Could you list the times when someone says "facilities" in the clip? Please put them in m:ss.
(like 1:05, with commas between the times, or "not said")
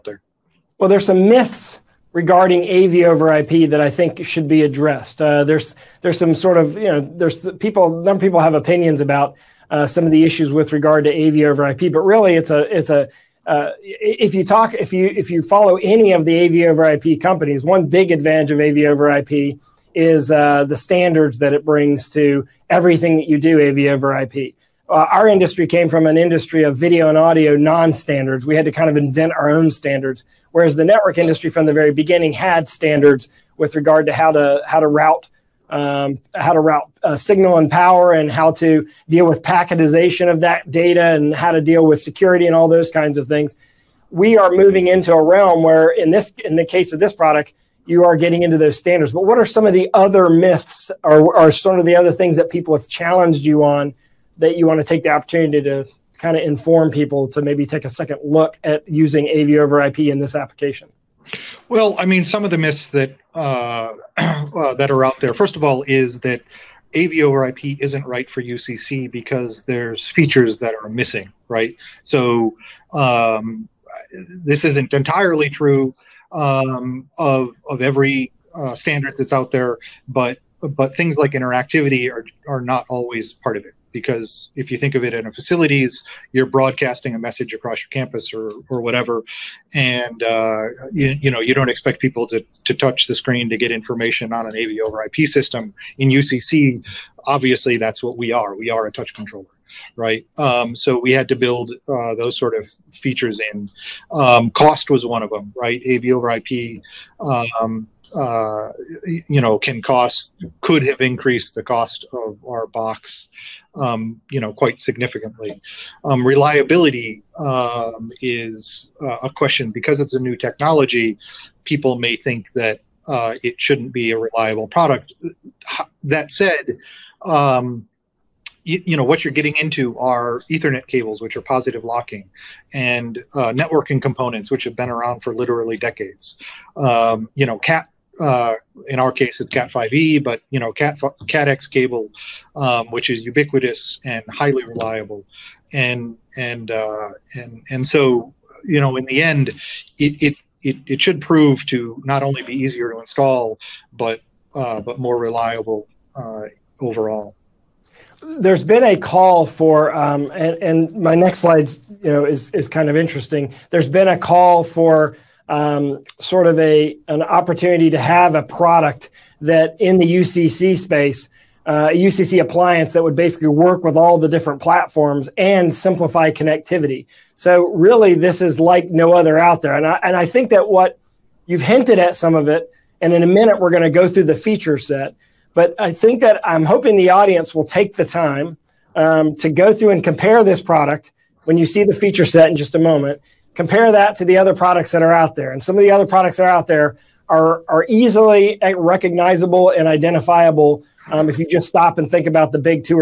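1:25.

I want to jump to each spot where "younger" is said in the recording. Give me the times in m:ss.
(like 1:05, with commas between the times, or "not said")
not said.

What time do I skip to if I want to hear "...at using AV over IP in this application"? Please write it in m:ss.
0:58.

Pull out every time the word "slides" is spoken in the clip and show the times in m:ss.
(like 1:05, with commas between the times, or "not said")
2:41.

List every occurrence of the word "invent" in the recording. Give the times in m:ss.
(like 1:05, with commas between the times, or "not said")
0:28.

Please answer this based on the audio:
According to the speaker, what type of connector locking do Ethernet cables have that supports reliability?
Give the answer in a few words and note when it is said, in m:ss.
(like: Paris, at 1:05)
Positive locking, at 2:11.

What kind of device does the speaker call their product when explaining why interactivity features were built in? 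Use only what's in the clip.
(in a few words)
A touch controller.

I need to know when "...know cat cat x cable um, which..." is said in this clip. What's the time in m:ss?
2:20.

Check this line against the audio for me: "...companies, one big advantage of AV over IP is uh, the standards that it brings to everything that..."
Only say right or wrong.
right.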